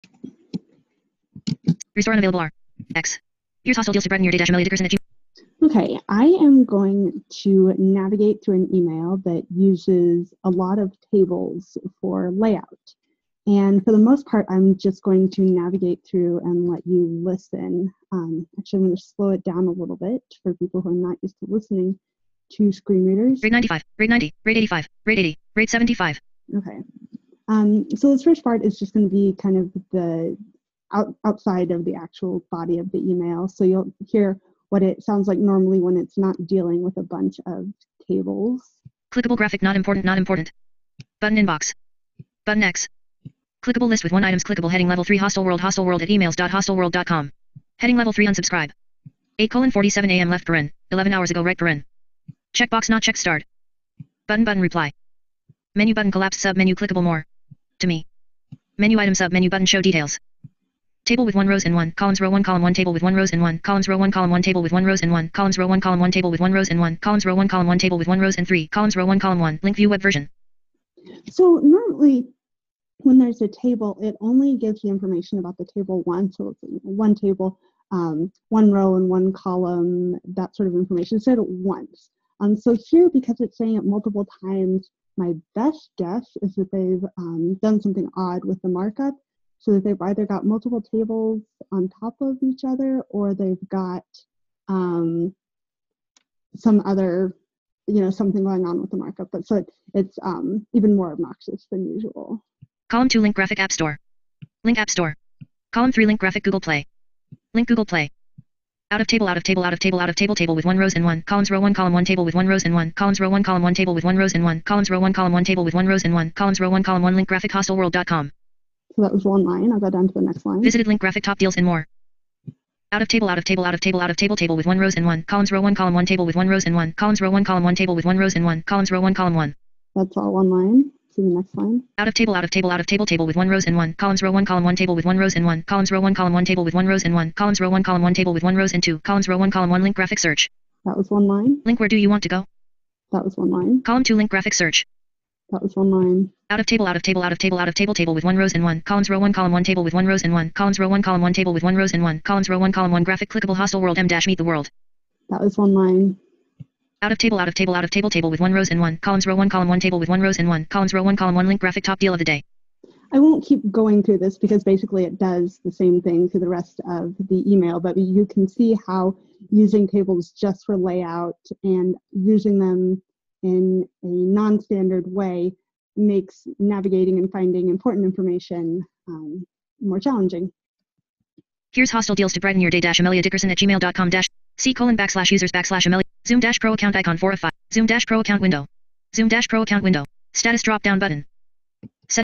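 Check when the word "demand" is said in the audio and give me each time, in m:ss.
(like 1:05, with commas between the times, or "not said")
not said.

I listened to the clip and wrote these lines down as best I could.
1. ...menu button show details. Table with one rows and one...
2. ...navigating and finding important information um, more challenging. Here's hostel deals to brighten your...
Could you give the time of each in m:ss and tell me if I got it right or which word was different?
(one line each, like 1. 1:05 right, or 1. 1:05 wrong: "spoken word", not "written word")
1. 0:59 right
2. 2:56 right.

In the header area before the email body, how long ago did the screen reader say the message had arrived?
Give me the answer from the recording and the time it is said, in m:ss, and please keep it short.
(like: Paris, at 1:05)
11 hours ago, at 0:50.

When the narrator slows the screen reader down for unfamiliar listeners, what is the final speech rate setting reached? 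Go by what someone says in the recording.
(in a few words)
75.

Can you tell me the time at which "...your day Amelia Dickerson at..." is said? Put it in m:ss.
0:04.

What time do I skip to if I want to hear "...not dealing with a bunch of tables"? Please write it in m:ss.
0:36.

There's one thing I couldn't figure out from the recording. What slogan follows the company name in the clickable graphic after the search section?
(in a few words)
Meet the world.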